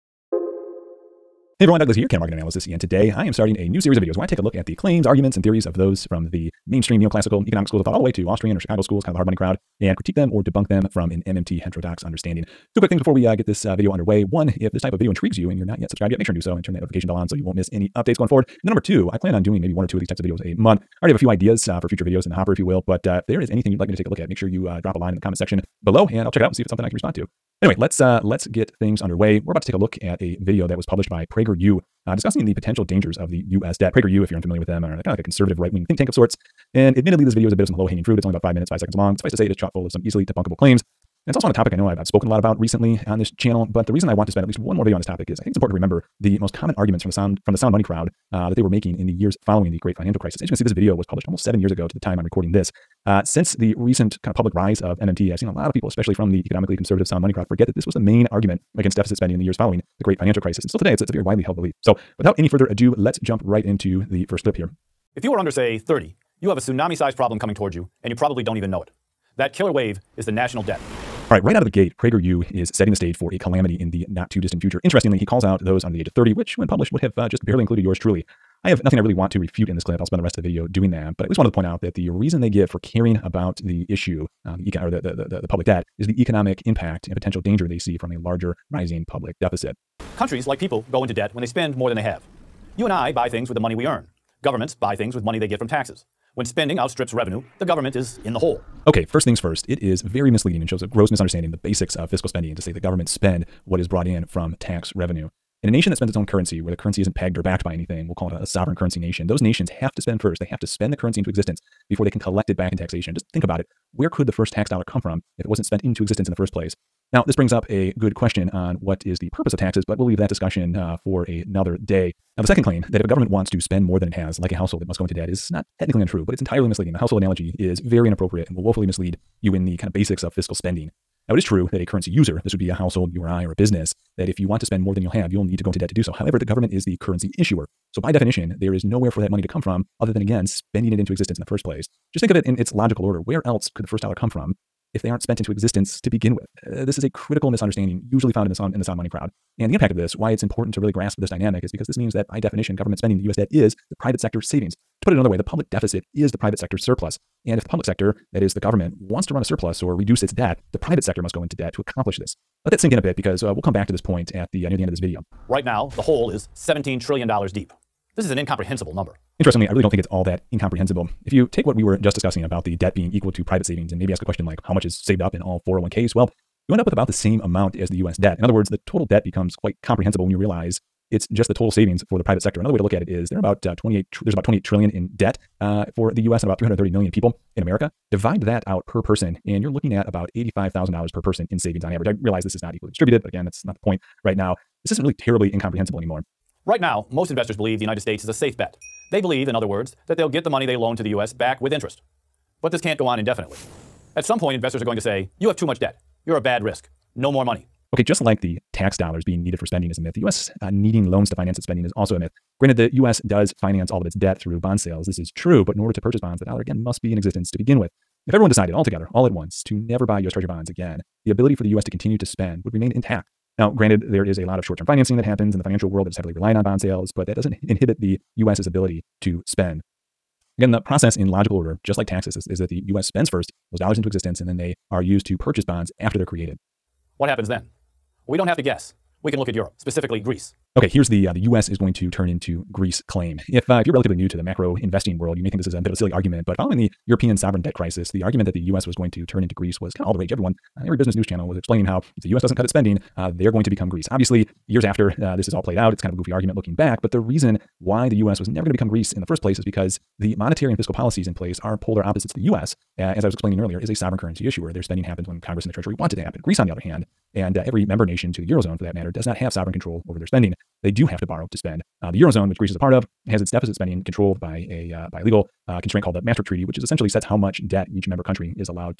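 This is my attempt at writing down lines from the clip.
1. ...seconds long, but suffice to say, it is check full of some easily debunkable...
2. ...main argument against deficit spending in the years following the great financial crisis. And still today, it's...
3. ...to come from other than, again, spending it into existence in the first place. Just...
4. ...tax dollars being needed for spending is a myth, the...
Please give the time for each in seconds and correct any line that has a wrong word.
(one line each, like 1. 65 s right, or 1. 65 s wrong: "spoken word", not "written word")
1. 38 s wrong: "chock", not "check"
2. 57 s right
3. 139 s right
4. 208 s right.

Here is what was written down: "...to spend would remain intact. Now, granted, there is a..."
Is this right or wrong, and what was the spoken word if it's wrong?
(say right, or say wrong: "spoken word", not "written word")
right.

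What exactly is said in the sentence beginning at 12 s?
Two quick things before we uh, get this uh, video underway.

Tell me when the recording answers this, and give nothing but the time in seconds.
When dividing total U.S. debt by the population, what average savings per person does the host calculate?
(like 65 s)
190 s.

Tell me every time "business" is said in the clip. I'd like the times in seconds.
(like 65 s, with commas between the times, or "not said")
133 s, 250 s.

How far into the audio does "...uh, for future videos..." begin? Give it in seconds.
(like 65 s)
21 s.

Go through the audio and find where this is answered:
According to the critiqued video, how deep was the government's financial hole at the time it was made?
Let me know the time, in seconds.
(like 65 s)
166 s.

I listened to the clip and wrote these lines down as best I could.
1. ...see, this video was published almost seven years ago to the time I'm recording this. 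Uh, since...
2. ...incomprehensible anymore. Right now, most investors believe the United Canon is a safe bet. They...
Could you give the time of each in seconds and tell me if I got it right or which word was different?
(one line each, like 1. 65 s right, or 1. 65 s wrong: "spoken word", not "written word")
1. 50 s right
2. 195 s wrong: "States", not "Canon".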